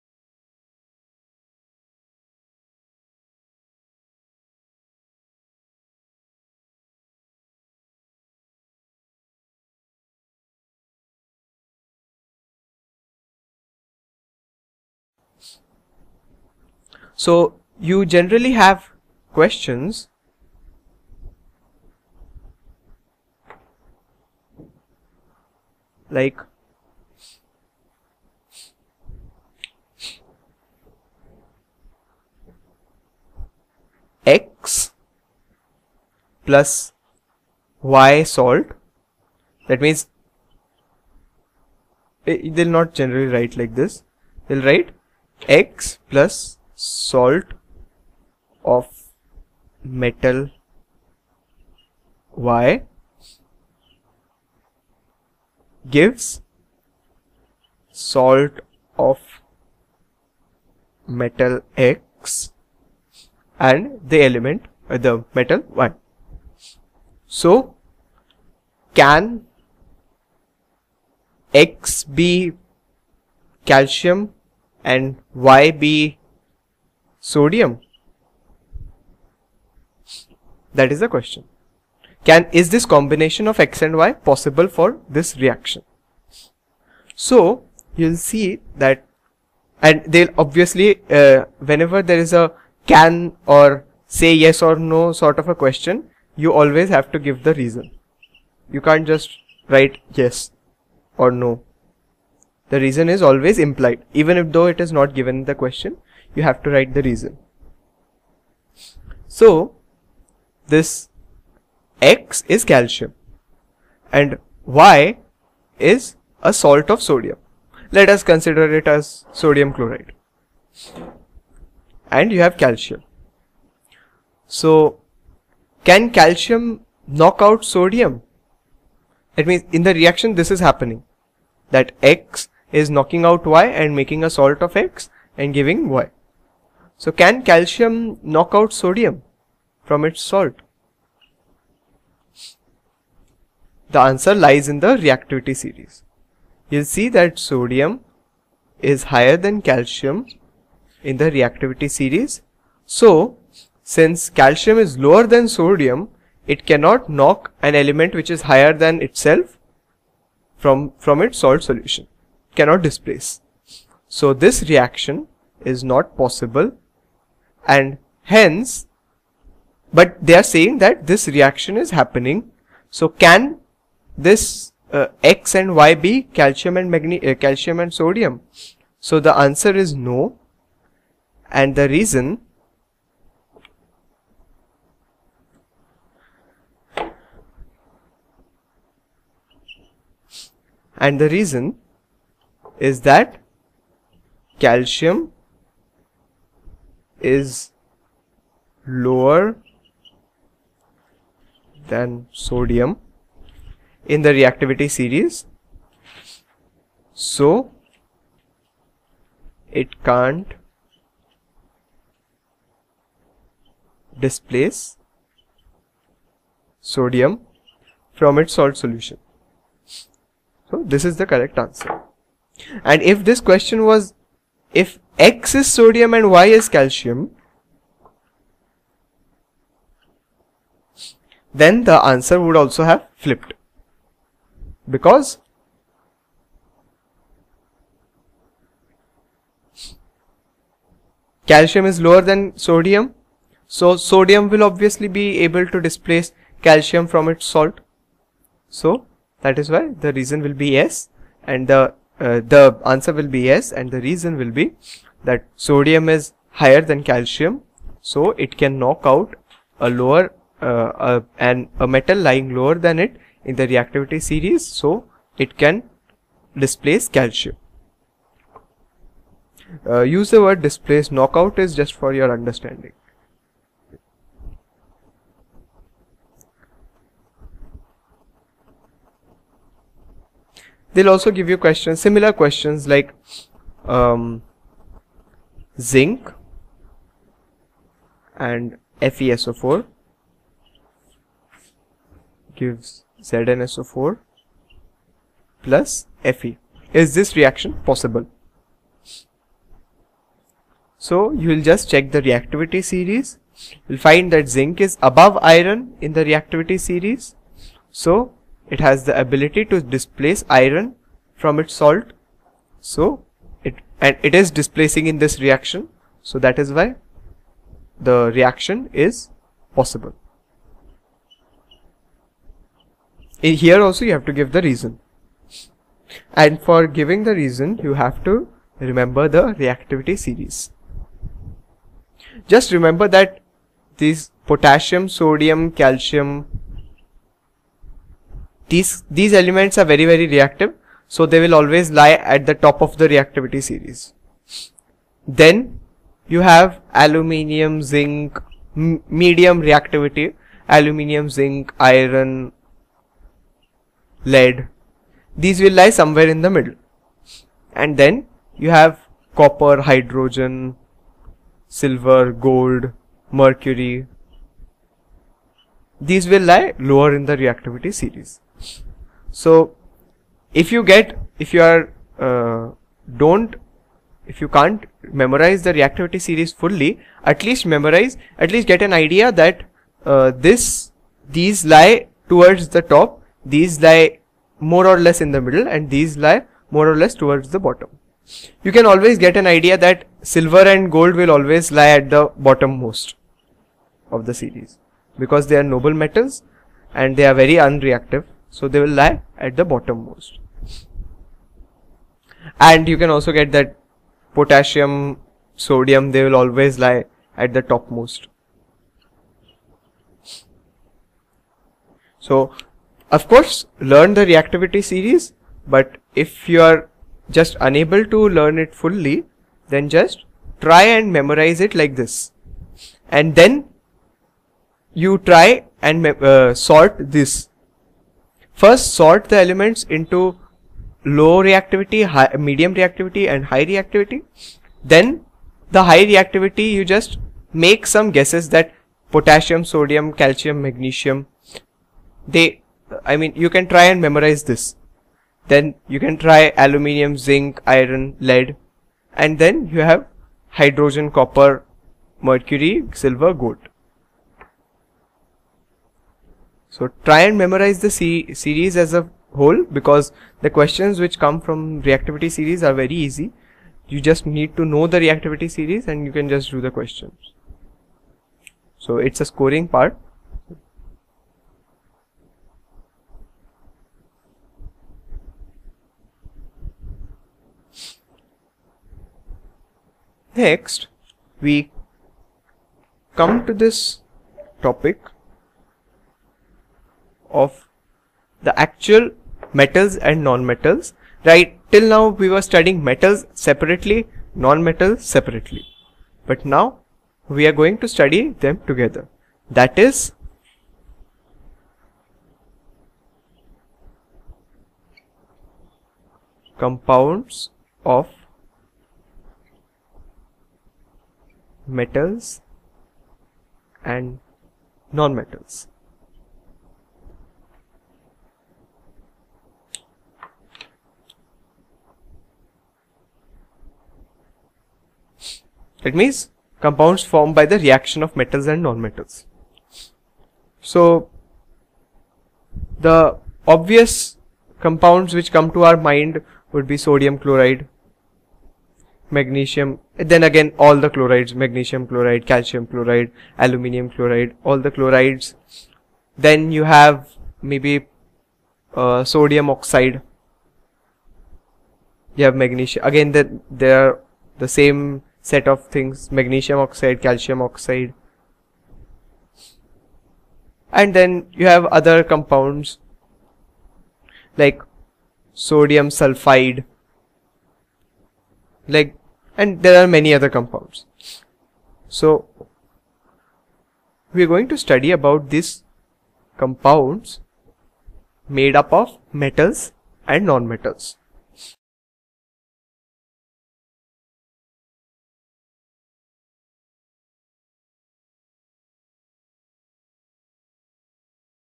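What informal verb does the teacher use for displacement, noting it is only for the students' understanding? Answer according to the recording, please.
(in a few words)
Knockout.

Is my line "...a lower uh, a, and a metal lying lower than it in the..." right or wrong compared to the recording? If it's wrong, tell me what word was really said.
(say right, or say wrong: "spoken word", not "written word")
right.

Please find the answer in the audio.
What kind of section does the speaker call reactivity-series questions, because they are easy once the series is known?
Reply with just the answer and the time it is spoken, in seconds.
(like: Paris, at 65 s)
A scoring part, at 469 s.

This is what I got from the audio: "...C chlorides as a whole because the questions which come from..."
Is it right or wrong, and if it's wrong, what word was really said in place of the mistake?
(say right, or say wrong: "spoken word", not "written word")
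wrong: "series", not "chlorides".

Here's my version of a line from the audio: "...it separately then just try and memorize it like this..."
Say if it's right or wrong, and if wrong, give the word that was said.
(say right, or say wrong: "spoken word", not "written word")
wrong: "fully", not "separately".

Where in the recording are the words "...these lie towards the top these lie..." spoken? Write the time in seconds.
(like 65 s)
381 s.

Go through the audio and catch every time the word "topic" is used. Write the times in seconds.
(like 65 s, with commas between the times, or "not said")
484 s.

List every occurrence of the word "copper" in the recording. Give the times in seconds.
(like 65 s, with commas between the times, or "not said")
359 s, 451 s.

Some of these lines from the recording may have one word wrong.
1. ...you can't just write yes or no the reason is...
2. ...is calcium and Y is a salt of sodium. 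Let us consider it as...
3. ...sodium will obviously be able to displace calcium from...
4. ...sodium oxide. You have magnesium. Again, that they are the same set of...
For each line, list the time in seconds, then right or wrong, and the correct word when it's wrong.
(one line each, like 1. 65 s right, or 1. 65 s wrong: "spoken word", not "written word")
1. 98 s right
2. 112 s right
3. 243 s right
4. 549 s right.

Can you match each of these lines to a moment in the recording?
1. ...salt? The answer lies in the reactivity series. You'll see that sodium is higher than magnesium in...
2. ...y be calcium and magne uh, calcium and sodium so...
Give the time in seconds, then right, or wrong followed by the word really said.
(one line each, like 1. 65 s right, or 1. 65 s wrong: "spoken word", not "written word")
1. 140 s wrong: "calcium", not "magnesium"
2. 175 s right.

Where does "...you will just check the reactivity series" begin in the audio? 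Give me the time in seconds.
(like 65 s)
301 s.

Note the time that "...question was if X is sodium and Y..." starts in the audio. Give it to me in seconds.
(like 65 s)
223 s.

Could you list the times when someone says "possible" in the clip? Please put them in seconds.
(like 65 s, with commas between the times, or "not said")
84 s, 166 s, 297 s, 319 s.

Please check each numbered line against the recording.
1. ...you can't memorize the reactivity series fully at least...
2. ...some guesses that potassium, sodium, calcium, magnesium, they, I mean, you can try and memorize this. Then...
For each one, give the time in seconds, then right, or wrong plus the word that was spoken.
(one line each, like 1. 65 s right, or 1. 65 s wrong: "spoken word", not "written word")
1. 374 s right
2. 437 s right.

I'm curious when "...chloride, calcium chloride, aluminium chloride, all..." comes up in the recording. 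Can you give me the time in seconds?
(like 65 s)
541 s.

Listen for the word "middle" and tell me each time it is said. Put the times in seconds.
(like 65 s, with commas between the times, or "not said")
356 s, 385 s.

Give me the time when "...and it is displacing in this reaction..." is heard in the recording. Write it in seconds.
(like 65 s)
314 s.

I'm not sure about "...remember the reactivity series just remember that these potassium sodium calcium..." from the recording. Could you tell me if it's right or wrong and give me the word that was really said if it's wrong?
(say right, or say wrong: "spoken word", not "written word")
right.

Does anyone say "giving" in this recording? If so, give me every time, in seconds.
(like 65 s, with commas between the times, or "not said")
135 s, 326 s.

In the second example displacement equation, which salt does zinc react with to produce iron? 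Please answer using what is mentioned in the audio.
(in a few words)
FeSO4.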